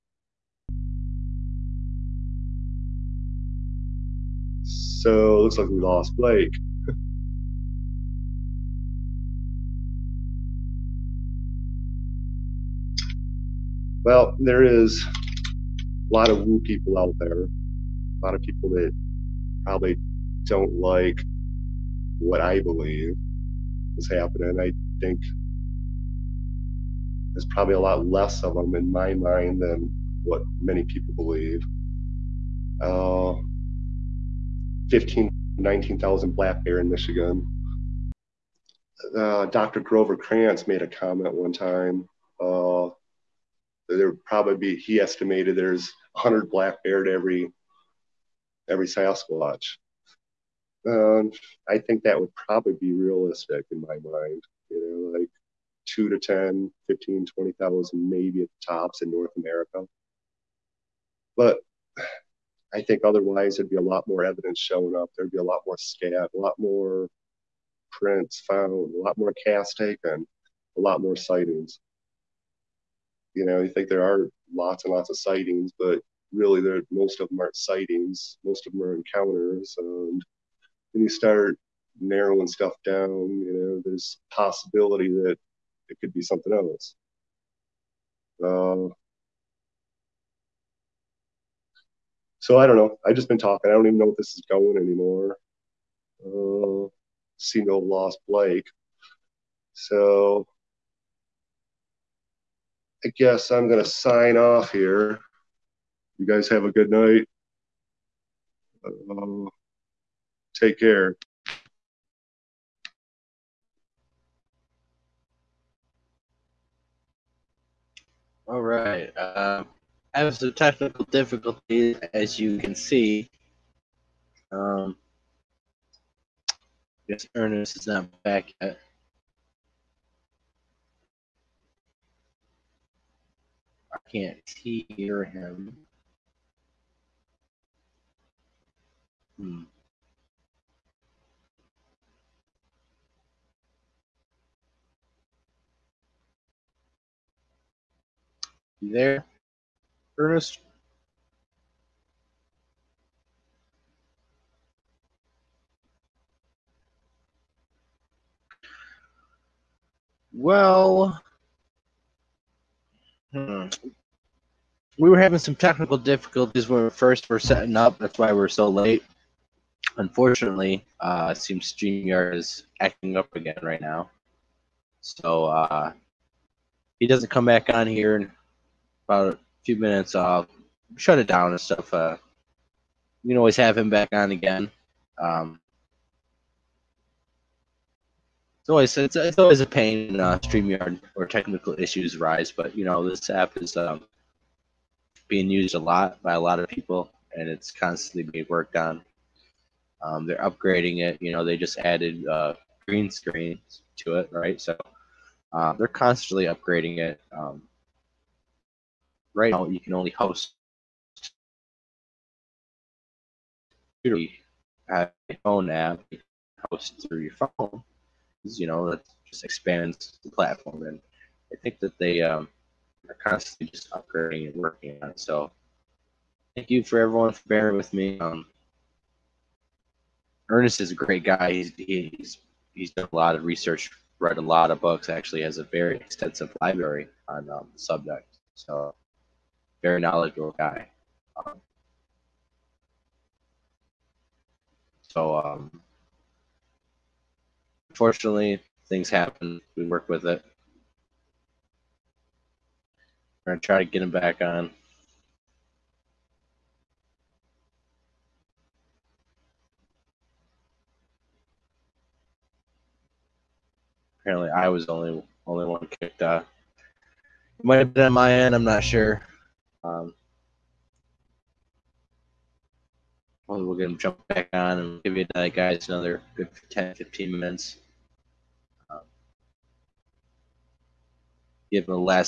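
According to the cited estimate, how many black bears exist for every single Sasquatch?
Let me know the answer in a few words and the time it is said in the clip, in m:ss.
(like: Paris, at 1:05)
100, at 0:46.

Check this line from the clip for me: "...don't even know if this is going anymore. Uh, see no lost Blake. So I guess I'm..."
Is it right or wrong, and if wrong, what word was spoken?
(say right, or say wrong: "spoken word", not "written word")
right.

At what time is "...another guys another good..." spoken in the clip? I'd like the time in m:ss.
4:35.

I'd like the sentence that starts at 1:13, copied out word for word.
You know, you think there are lots and lots of sightings, but really, there most of them aren't sightings.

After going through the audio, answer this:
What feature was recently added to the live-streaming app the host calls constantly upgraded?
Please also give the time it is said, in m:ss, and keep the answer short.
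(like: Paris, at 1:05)
green screens, at 3:22.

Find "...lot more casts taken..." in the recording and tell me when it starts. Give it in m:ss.
1:09.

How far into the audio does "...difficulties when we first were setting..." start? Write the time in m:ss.
2:45.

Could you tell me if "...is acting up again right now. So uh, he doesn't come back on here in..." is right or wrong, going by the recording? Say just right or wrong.
right.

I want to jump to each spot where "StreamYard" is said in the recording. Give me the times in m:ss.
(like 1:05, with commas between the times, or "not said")
2:51, 3:10.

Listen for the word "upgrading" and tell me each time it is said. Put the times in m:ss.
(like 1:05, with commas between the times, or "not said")
3:20, 3:26, 3:43.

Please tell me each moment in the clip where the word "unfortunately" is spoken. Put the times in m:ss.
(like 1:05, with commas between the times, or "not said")
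2:49, 4:07.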